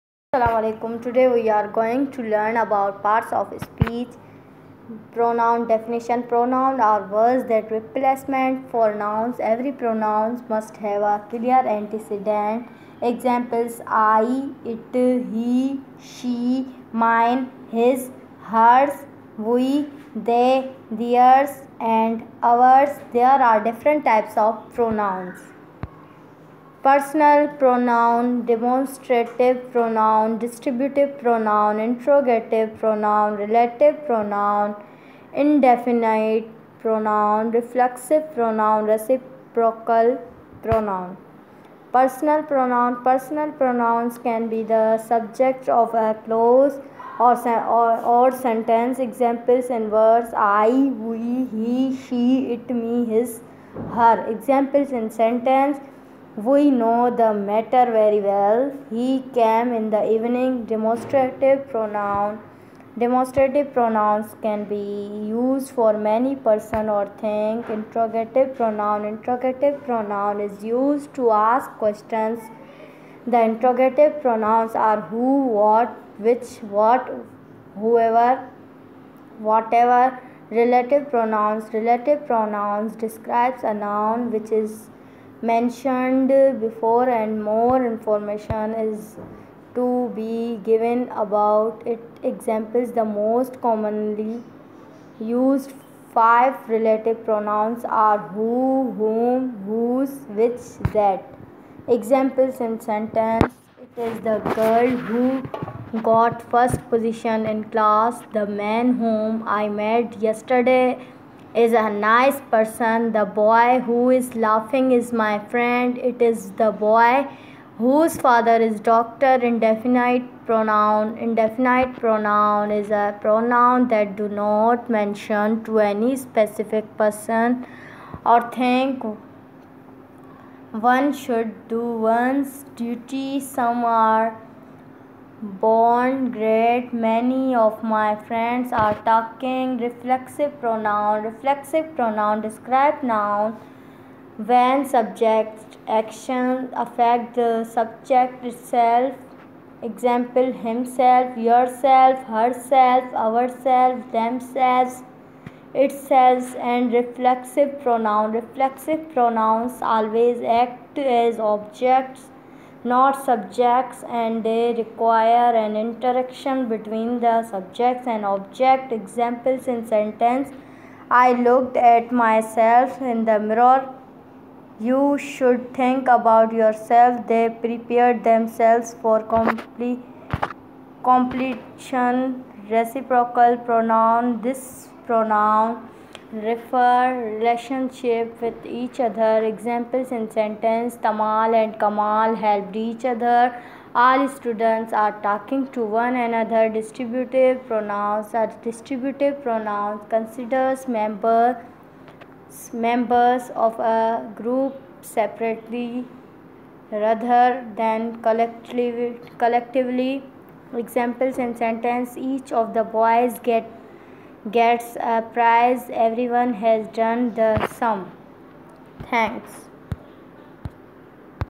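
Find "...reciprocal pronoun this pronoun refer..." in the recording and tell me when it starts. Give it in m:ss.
3:02.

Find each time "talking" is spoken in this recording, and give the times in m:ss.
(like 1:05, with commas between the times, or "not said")
2:19, 3:15.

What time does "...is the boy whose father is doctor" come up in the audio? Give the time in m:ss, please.
1:56.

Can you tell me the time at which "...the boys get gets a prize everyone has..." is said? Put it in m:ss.
3:32.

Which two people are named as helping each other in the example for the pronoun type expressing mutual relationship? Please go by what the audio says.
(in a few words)
Tamal and Kamal.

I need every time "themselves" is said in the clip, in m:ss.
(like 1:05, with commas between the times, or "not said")
2:34, 2:58.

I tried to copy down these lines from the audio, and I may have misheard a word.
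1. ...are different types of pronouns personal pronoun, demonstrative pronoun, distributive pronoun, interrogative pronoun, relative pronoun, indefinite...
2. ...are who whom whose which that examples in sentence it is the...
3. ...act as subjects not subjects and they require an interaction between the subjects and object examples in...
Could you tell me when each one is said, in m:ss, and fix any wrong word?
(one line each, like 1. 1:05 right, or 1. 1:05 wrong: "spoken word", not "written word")
1. 0:23 right
2. 1:38 right
3. 2:40 wrong: "objects", not "subjects".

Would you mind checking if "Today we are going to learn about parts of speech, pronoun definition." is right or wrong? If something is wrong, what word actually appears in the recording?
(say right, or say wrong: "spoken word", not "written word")
right.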